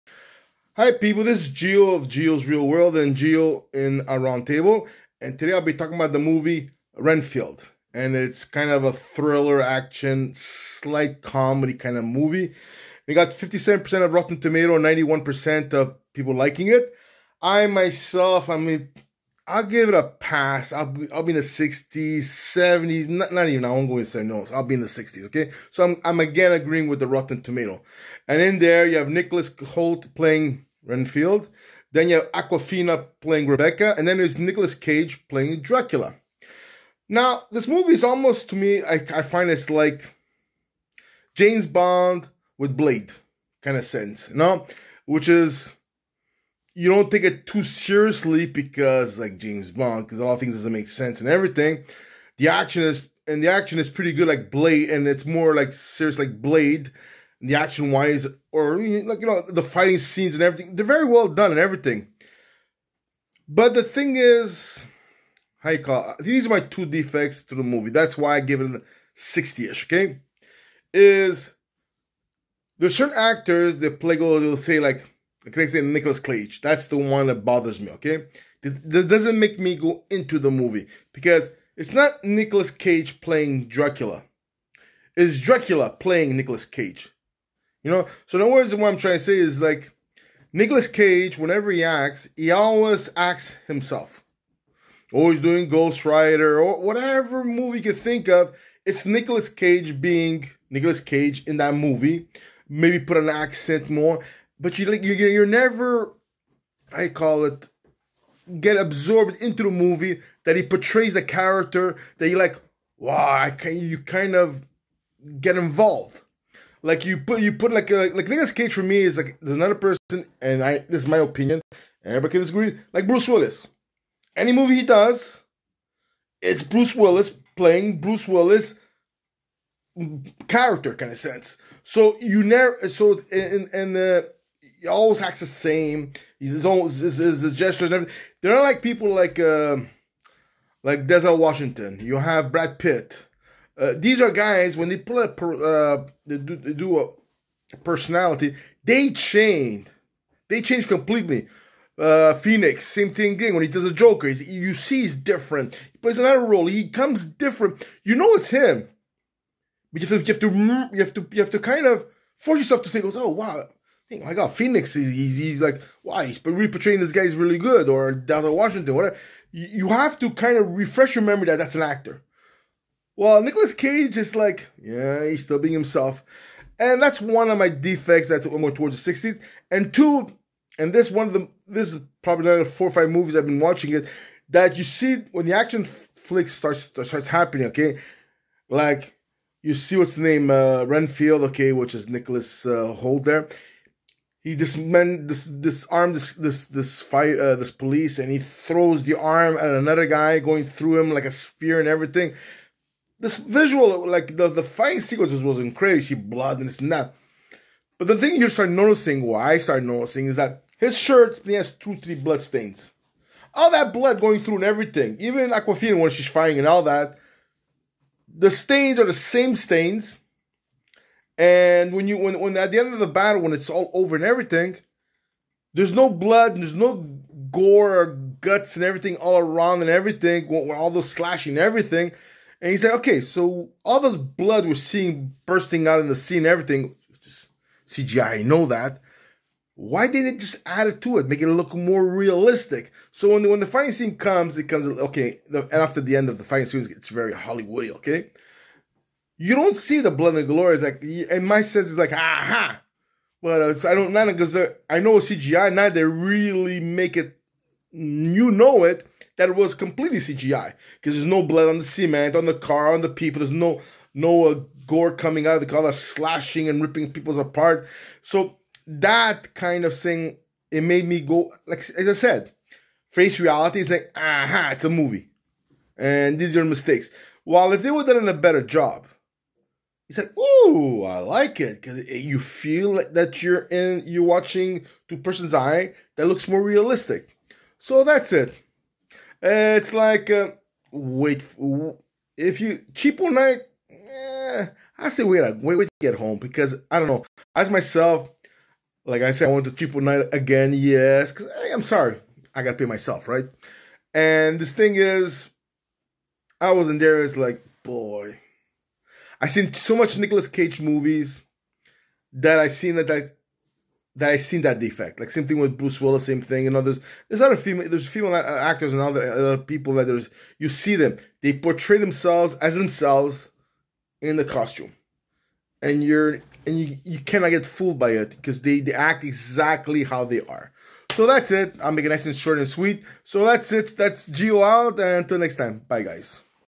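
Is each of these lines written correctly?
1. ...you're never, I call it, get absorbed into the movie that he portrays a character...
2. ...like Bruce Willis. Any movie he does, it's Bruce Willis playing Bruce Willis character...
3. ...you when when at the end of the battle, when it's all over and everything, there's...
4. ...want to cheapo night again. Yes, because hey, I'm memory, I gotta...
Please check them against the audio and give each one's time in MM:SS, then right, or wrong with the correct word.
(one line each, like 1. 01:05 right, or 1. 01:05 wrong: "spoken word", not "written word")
1. 01:45 right
2. 02:02 right
3. 03:42 right
4. 04:59 wrong: "sorry", not "memory".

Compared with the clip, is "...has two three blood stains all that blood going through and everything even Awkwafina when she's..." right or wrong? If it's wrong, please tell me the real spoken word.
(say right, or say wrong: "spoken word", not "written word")
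right.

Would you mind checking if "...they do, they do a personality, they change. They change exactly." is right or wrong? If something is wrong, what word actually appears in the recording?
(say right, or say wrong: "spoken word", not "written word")
wrong: "completely", not "exactly".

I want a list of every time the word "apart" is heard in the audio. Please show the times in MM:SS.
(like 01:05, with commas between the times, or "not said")
04:27.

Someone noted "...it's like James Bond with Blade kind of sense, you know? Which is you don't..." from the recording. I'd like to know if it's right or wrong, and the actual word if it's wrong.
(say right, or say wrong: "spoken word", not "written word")
right.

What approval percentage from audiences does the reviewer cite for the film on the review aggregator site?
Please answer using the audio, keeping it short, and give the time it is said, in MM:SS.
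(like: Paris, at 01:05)
91%, at 00:14.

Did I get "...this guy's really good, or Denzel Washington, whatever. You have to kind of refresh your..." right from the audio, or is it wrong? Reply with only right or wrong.
right.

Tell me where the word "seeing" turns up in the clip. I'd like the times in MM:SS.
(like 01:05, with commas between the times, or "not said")
03:54.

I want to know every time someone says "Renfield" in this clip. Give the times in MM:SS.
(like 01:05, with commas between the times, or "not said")
00:06, 00:30, 03:10.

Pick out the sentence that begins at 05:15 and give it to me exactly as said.
Like same thing with Bruce Willis, same thing.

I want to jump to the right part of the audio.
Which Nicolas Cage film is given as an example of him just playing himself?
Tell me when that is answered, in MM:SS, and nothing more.
01:35.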